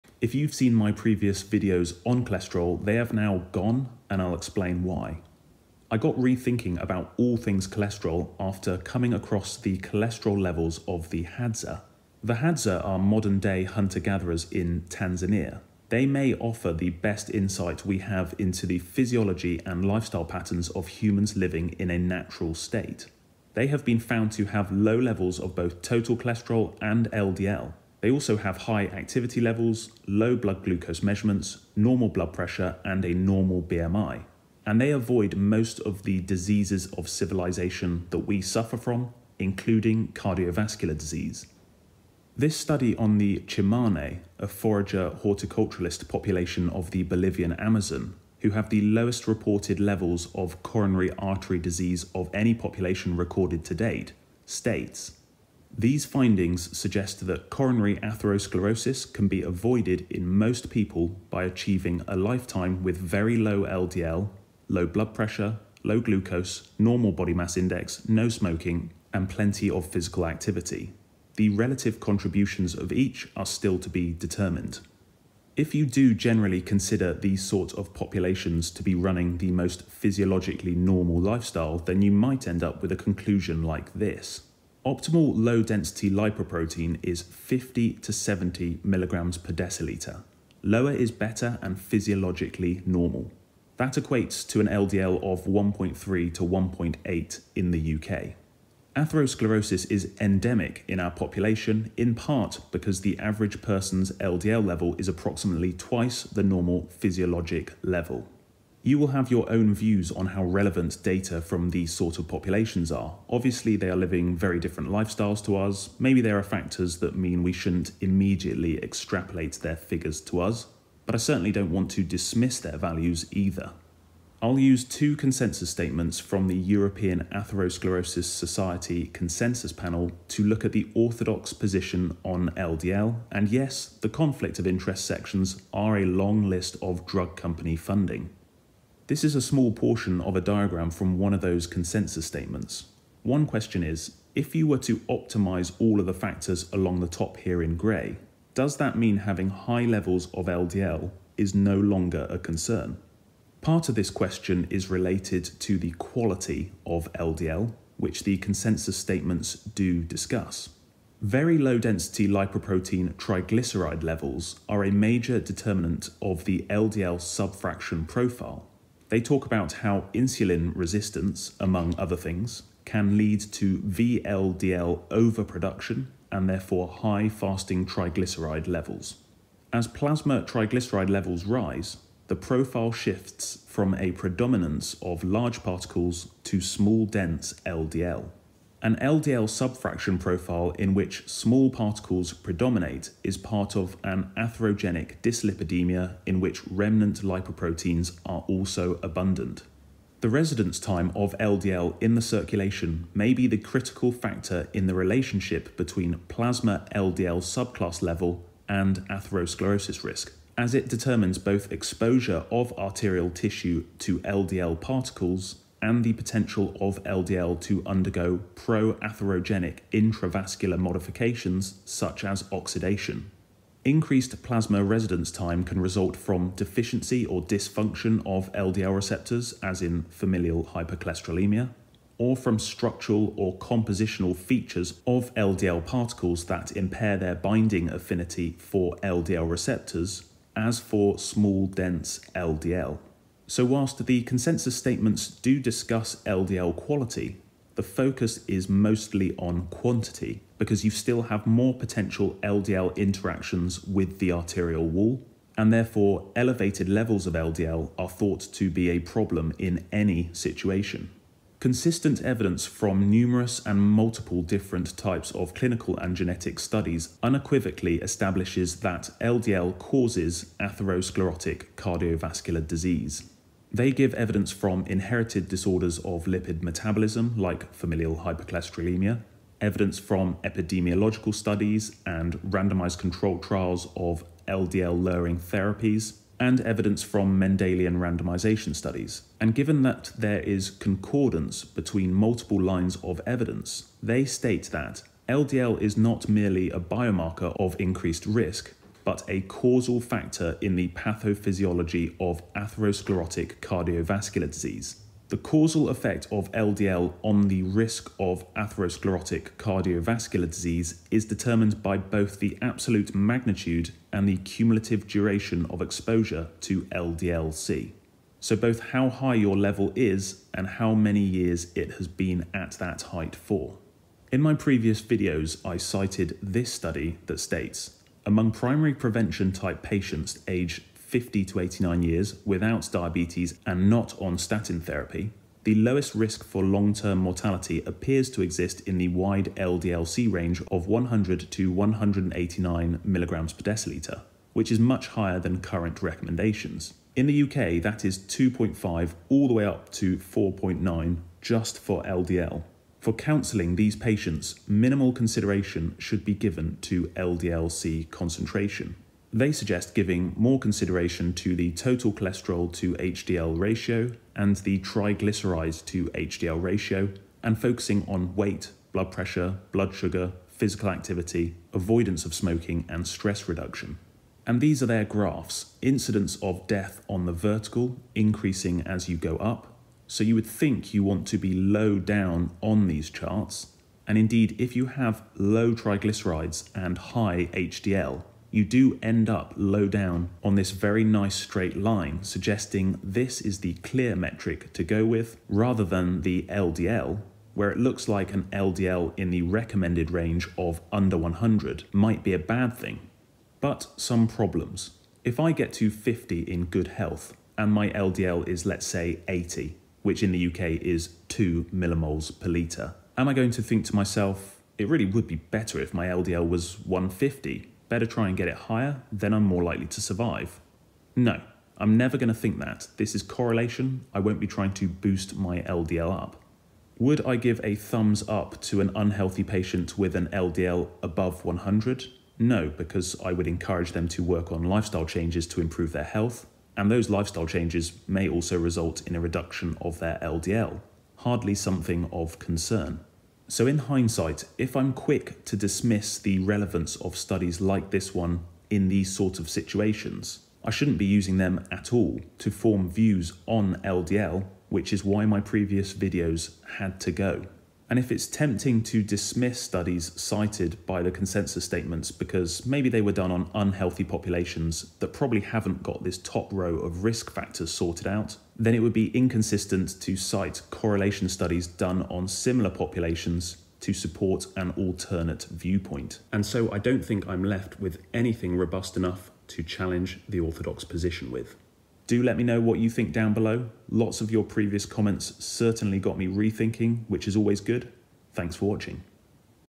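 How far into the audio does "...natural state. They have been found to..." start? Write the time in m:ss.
0:21.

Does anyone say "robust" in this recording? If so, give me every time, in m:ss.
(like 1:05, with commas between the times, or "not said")
7:58.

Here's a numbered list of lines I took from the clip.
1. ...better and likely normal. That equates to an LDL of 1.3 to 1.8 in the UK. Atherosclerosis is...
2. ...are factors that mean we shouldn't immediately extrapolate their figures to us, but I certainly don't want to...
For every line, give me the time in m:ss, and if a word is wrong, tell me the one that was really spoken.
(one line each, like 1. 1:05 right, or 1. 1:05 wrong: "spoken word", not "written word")
1. 1:31 wrong: "physiologically", not "likely"
2. 1:56 right.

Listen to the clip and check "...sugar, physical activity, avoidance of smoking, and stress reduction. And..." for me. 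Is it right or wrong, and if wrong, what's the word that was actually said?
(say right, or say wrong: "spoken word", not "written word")
right.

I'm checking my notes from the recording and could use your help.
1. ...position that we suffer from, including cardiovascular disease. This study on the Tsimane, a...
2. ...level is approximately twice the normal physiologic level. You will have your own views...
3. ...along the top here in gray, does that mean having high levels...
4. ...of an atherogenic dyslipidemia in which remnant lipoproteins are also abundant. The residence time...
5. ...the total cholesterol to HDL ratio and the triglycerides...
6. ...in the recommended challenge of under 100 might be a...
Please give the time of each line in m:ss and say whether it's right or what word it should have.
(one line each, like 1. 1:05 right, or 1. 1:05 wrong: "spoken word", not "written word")
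1. 0:37 wrong: "civilization", not "position"
2. 1:44 right
3. 2:26 right
4. 3:13 right
5. 6:01 right
6. 6:39 wrong: "range", not "challenge".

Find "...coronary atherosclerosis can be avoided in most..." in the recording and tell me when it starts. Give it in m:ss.
0:57.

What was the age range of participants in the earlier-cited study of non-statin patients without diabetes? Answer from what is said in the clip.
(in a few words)
50 to 89 years.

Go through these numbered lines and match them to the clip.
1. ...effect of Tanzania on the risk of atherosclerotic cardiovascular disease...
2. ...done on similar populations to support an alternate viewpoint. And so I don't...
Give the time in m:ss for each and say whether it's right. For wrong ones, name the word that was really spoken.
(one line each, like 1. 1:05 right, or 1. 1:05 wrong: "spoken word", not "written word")
1. 5:05 wrong: "LDL", not "Tanzania"
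2. 7:51 right.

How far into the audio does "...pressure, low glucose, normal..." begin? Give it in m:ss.
1:05.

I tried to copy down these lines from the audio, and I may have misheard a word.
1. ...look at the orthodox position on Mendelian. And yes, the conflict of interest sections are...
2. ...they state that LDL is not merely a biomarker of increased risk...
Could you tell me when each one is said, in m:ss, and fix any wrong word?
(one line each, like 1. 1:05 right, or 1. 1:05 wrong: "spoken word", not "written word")
1. 2:10 wrong: "LDL", not "Mendelian"
2. 4:54 right.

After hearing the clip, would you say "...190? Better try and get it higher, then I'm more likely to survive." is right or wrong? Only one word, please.
wrong.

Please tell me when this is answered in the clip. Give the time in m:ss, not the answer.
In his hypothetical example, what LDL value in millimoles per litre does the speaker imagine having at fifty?
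6:51.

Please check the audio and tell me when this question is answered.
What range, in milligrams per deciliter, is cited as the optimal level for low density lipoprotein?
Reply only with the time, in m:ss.
1:27.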